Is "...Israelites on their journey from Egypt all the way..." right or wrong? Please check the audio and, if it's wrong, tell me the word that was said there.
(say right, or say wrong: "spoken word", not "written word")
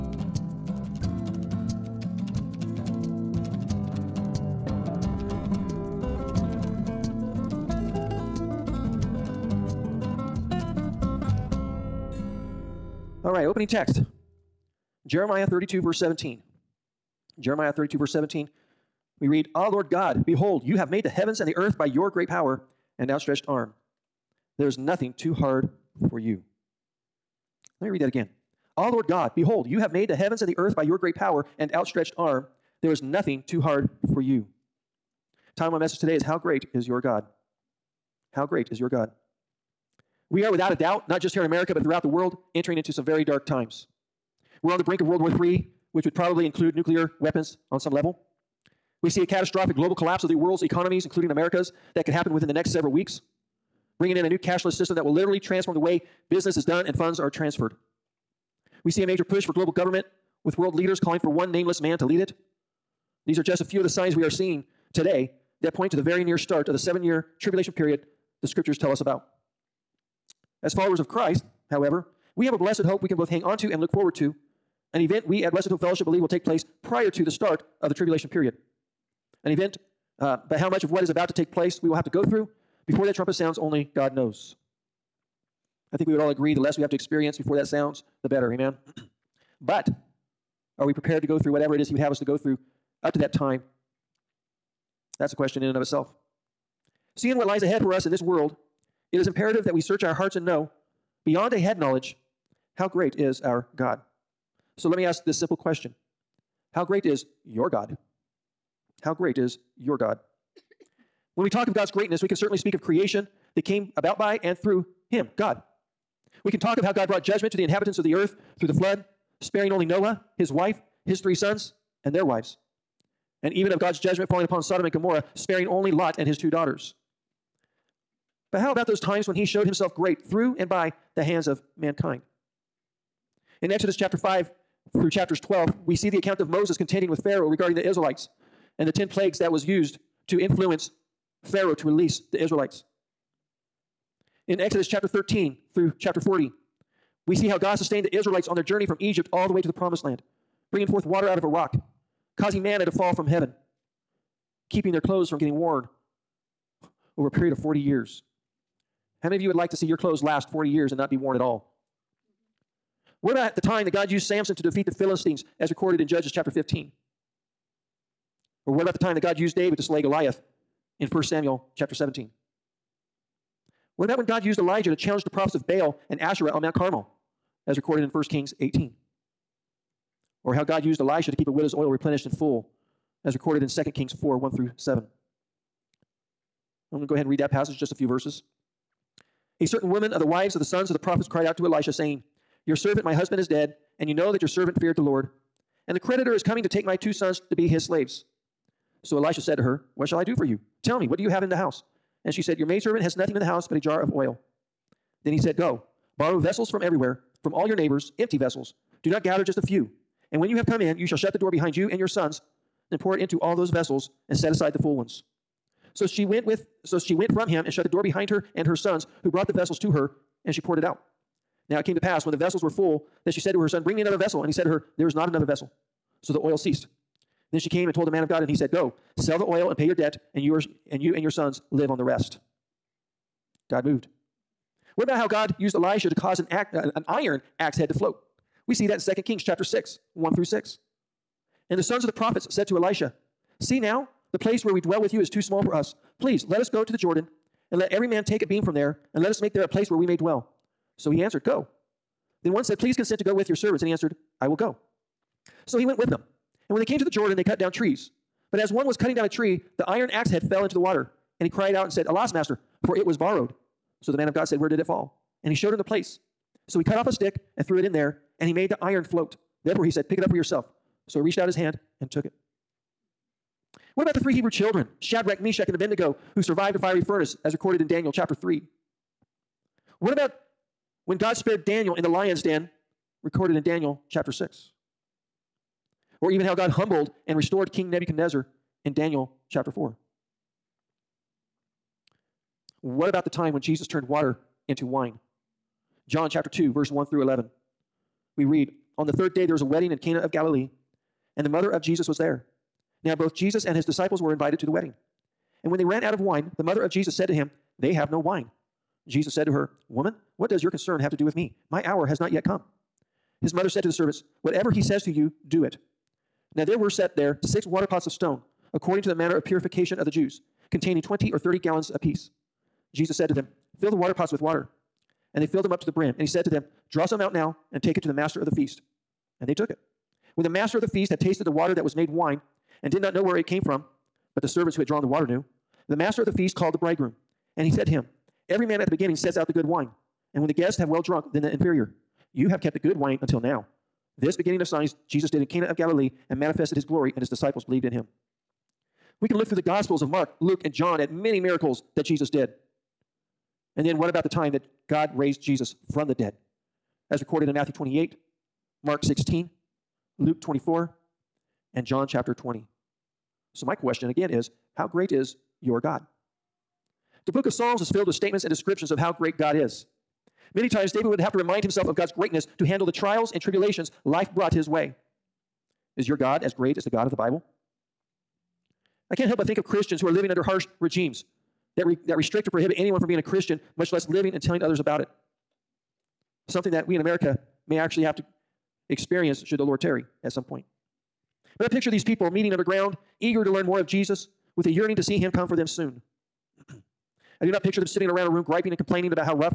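right.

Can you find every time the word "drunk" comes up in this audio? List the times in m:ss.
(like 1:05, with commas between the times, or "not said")
5:41.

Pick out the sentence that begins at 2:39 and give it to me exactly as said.
How many of you would like to see your clothes last 40 years and not be worn at all?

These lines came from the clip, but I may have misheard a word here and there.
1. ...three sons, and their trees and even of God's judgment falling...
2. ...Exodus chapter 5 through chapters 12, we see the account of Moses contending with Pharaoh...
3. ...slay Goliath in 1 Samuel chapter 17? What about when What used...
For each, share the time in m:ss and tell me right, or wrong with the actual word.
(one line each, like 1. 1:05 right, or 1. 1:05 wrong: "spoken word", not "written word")
1. 2:01 wrong: "wives", not "trees"
2. 2:13 right
3. 2:49 wrong: "God", not "What".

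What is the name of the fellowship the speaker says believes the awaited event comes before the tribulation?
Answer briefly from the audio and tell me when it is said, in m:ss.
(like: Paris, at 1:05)
Blessed Hope Fellowship, at 1:15.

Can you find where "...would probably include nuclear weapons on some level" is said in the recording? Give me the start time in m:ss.
0:46.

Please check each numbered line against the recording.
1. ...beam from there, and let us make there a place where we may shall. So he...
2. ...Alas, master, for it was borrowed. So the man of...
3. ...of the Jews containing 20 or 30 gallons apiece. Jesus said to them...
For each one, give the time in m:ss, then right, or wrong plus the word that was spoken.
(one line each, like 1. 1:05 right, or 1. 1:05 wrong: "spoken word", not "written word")
1. 4:08 wrong: "dwell", not "shall"
2. 4:22 right
3. 5:19 right.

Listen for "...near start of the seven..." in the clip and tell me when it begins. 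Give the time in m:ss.
1:06.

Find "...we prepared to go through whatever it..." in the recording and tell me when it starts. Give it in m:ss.
1:30.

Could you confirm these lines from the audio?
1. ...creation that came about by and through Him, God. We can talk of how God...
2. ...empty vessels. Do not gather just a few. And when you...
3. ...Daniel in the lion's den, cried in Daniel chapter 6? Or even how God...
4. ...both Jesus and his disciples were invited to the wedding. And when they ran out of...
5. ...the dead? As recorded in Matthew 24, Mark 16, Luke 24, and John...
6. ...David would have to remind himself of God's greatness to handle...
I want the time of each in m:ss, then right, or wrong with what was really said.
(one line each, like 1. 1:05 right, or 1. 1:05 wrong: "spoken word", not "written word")
1. 1:52 right
2. 3:28 right
3. 4:41 wrong: "recorded", not "cried"
4. 5:03 right
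5. 5:56 wrong: "28", not "24"
6. 6:10 right.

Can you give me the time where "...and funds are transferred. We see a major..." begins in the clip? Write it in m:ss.
0:56.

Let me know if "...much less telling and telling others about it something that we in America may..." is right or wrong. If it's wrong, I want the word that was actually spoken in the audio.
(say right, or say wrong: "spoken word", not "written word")
wrong: "living", not "telling".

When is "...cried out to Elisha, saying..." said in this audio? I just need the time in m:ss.
3:11.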